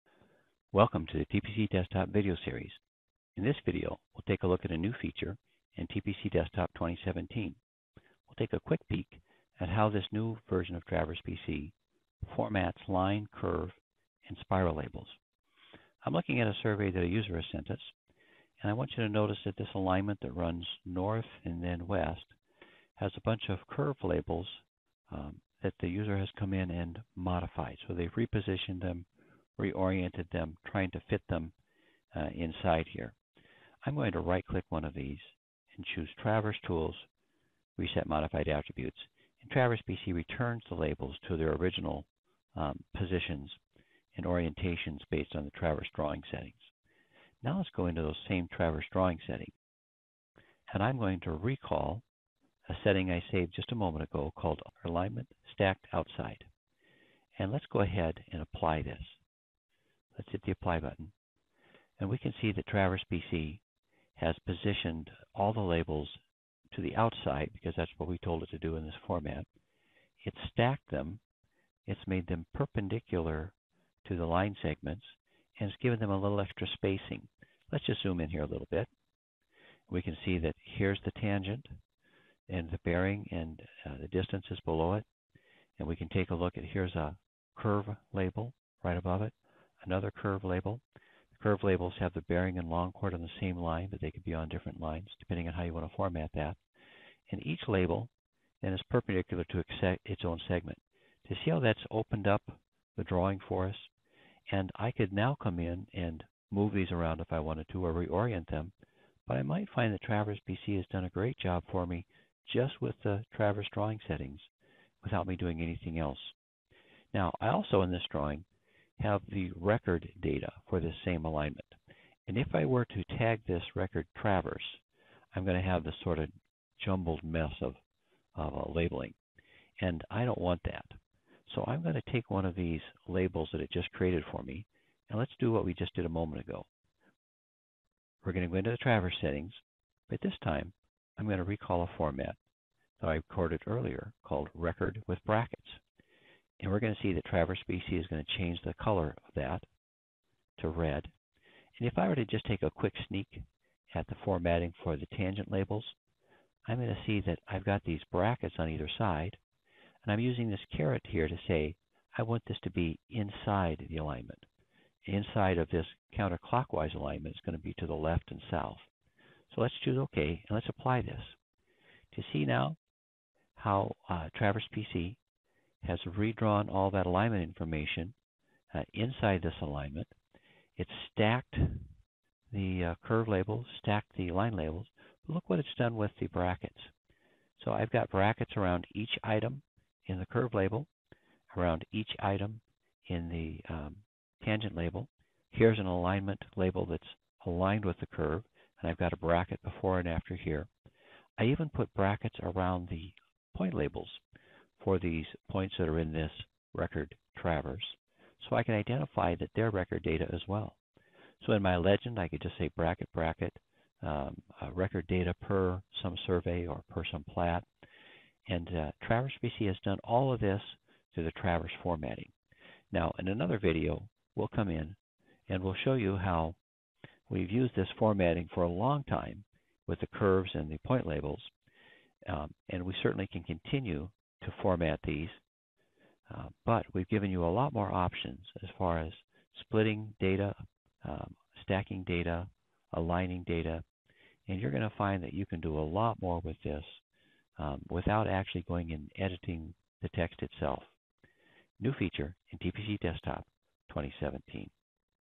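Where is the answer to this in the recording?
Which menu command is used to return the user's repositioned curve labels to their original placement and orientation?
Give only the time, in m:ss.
0:37.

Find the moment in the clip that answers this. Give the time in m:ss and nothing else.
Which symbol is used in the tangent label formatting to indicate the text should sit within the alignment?
2:40.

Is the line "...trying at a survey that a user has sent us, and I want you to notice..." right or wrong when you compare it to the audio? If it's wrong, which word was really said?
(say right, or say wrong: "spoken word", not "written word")
wrong: "looking", not "trying".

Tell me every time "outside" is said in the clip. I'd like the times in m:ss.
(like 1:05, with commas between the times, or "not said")
0:55, 1:06.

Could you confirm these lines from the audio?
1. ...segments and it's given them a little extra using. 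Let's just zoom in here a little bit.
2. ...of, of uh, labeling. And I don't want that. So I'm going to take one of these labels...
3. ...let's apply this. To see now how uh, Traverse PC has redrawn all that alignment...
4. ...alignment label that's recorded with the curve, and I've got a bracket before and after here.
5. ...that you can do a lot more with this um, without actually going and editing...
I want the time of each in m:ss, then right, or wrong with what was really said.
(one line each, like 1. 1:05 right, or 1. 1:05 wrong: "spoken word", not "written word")
1. 1:14 wrong: "spacing", not "using"
2. 2:07 right
3. 2:50 right
4. 3:15 wrong: "aligned", not "recorded"
5. 4:05 right.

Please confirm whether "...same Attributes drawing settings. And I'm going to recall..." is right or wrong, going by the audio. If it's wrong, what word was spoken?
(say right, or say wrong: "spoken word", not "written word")
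wrong: "Traverse", not "Attributes".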